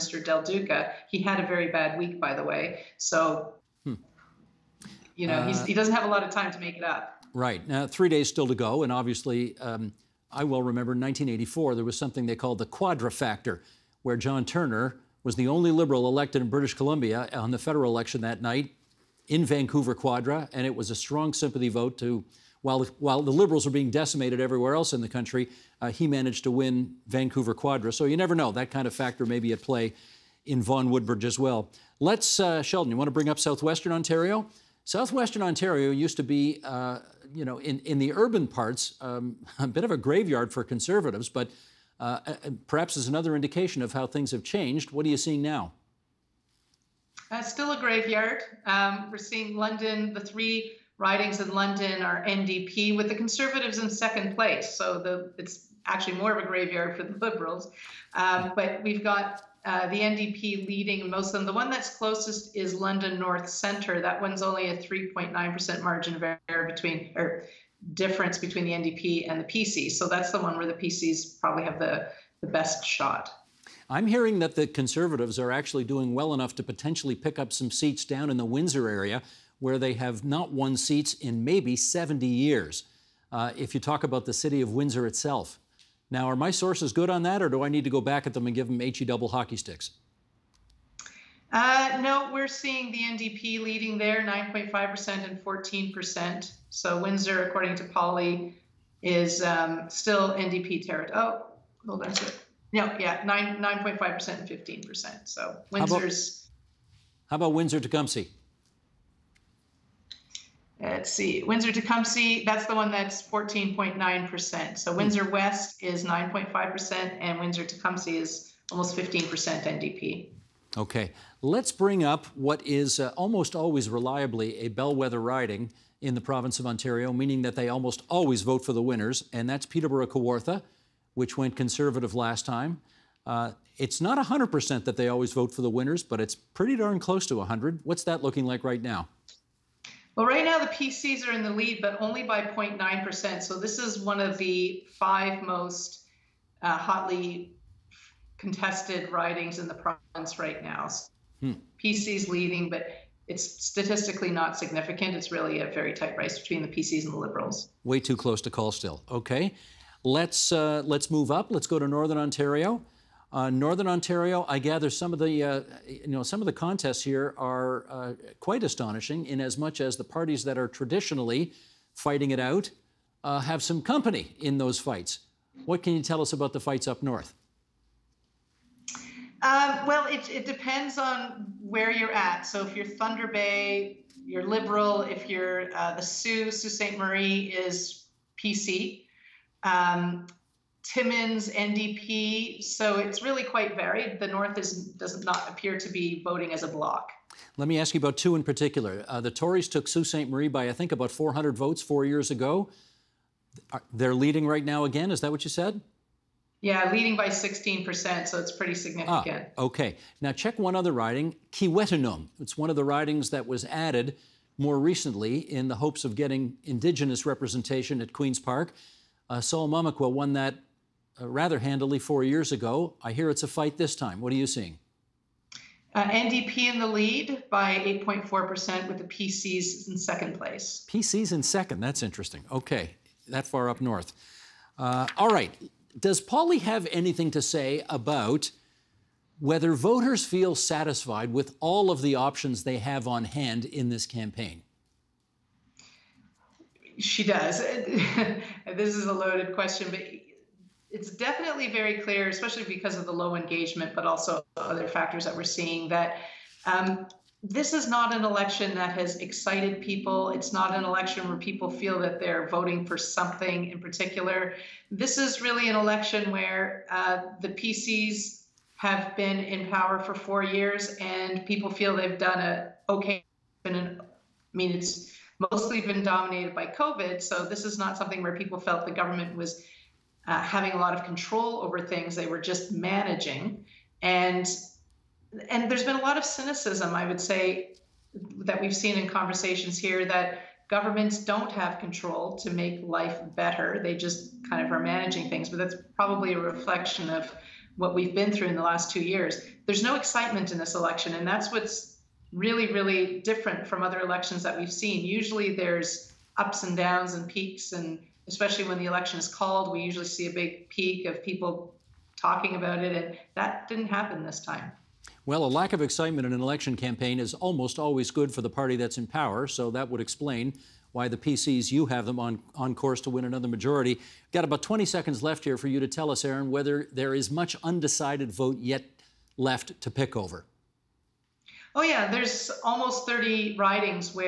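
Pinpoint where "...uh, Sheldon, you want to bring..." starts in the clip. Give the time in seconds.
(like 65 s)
32 s.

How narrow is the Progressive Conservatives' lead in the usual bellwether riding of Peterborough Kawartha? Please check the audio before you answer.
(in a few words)
0.9%.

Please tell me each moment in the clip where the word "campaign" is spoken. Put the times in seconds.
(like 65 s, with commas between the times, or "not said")
244 s, 316 s.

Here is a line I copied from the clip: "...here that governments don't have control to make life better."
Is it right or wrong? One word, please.
right.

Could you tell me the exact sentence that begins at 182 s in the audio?
So if you're Thunder Bay, you're liberal.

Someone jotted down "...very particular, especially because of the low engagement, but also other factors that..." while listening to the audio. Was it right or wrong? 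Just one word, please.
wrong.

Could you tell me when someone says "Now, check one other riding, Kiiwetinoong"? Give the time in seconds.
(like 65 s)
210 s.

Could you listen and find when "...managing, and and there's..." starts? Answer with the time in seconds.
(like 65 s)
282 s.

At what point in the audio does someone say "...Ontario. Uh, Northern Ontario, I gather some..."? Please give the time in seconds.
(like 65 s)
162 s.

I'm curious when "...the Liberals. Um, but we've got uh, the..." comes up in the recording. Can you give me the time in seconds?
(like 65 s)
57 s.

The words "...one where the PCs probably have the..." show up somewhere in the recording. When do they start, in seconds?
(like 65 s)
70 s.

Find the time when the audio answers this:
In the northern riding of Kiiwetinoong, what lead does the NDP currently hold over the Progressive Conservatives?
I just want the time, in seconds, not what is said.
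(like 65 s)
228 s.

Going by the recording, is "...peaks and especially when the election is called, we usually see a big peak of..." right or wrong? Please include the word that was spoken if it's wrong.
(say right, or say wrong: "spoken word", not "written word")
right.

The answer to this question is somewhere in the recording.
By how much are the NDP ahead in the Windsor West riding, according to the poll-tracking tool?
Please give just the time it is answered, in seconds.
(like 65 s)
114 s.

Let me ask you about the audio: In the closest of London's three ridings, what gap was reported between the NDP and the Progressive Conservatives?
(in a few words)
3.9%.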